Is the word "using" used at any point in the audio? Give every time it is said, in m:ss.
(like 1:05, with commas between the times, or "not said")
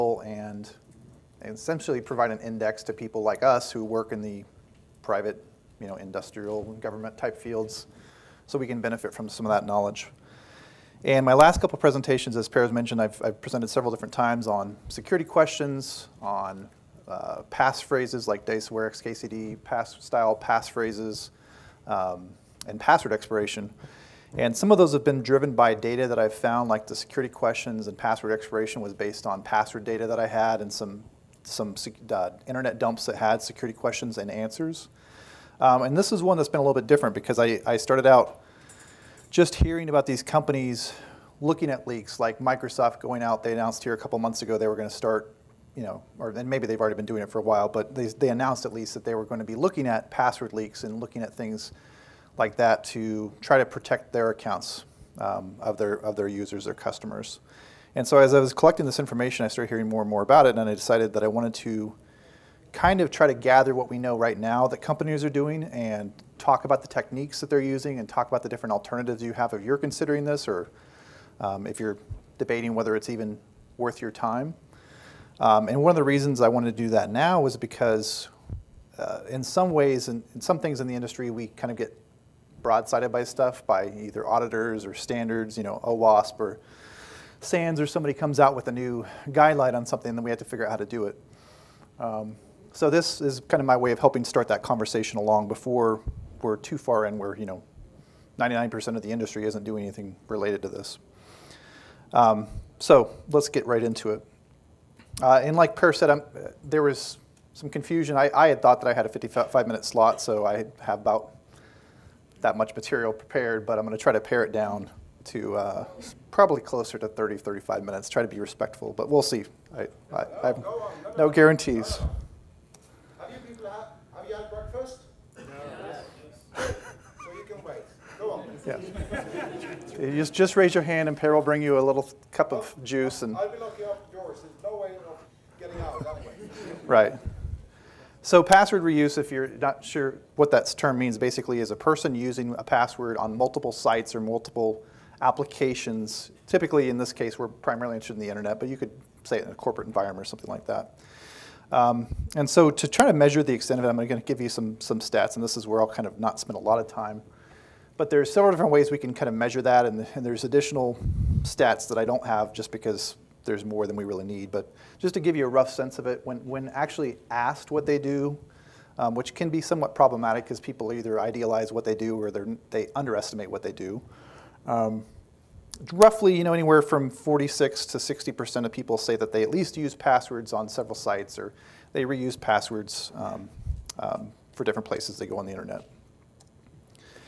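1:07, 2:22.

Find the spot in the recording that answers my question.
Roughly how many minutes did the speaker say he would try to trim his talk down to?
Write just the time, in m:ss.
1:57.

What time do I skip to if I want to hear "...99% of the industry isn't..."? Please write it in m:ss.
1:38.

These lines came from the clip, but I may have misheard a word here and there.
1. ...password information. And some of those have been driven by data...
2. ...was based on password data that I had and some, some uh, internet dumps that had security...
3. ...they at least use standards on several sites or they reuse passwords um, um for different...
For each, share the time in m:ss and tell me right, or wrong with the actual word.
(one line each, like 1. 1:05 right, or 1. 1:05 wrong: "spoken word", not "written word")
1. 0:22 wrong: "expiration", not "information"
2. 0:28 right
3. 2:59 wrong: "passwords", not "standards".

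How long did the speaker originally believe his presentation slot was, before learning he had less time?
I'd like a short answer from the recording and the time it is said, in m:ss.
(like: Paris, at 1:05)
55 minutes, at 1:49.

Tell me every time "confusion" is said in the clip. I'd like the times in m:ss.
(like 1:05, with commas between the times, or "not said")
1:47.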